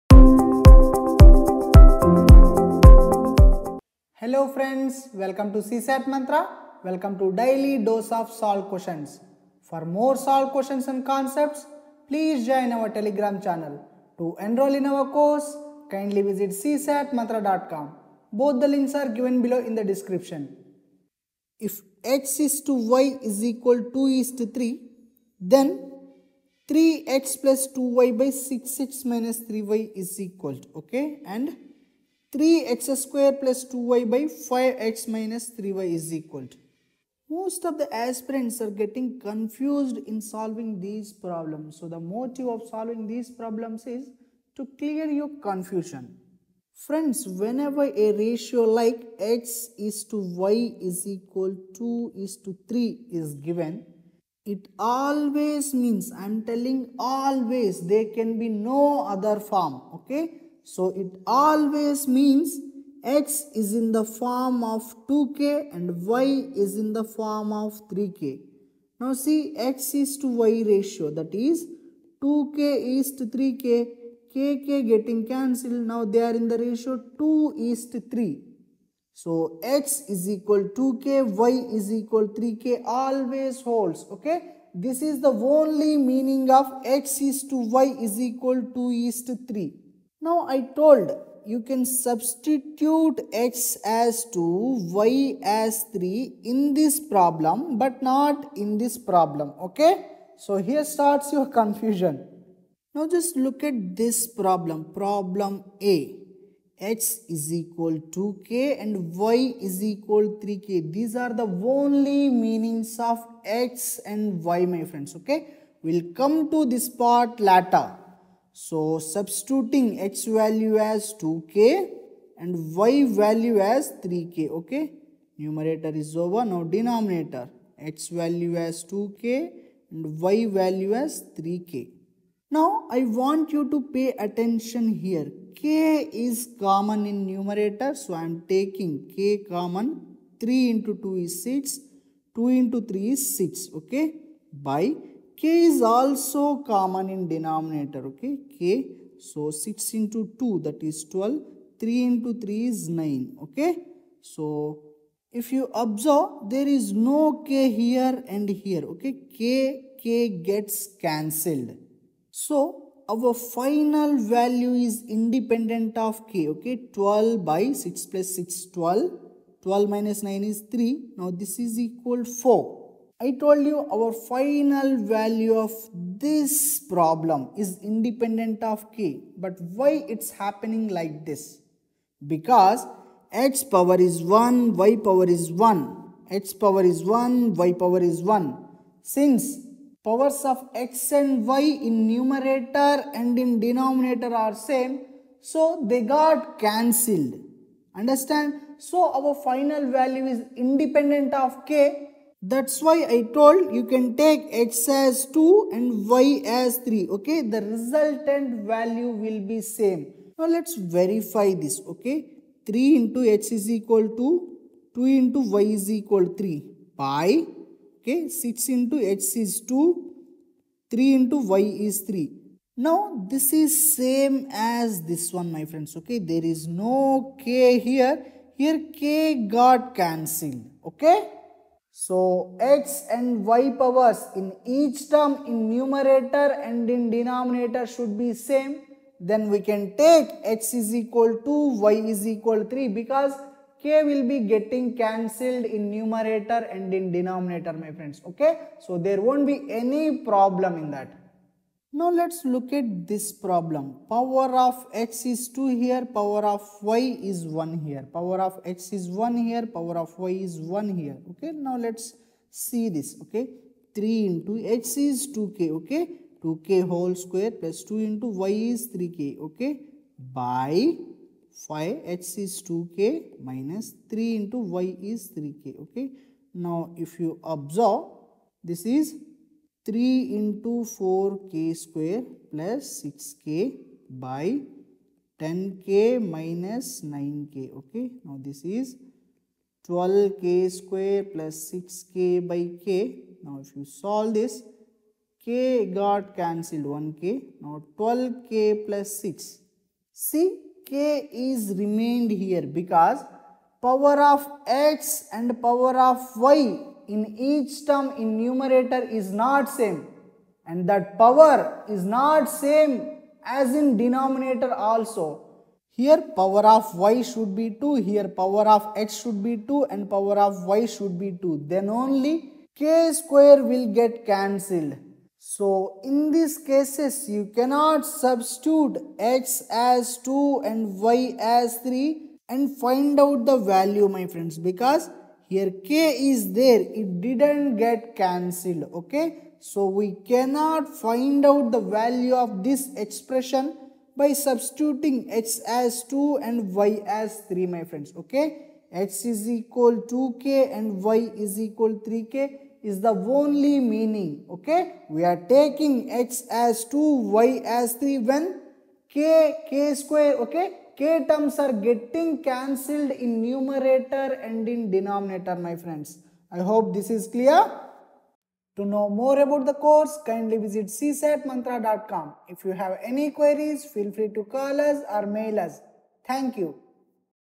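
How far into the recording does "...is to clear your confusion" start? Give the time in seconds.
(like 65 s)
43 s.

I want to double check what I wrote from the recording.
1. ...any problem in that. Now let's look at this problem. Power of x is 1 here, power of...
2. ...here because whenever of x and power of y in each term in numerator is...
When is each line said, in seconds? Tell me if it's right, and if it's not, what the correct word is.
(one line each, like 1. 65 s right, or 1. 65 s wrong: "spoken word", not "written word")
1. 249 s wrong: "2", not "1"
2. 302 s wrong: "power", not "whenever".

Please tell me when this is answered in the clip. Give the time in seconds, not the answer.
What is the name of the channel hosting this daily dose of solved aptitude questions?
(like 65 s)
5 s.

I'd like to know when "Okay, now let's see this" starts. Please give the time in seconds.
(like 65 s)
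261 s.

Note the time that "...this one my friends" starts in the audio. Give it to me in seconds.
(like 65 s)
225 s.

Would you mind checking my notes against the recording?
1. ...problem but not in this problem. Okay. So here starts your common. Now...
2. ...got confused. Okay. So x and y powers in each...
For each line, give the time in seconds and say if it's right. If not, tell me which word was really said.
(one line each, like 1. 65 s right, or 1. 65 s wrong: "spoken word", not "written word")
1. 96 s wrong: "confusion", not "common"
2. 229 s wrong: "cancelled", not "confused".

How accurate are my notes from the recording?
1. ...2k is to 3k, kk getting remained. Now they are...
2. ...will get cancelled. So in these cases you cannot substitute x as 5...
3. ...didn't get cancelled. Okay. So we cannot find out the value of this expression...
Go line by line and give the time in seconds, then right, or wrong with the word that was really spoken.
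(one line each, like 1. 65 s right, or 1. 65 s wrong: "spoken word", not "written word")
1. 72 s wrong: "cancelled", not "remained"
2. 323 s wrong: "2", not "5"
3. 337 s right.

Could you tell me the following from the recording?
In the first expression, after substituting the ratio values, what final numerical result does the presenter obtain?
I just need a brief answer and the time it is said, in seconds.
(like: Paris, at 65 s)
4, at 171 s.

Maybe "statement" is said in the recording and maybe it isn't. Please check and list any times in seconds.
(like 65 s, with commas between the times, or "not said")
not said.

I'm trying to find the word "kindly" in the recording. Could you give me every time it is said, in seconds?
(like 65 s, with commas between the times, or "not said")
15 s, 370 s.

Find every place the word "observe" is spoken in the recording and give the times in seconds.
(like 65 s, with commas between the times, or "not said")
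155 s, 277 s.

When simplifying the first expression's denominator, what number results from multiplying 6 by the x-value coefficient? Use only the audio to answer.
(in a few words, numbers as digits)
12.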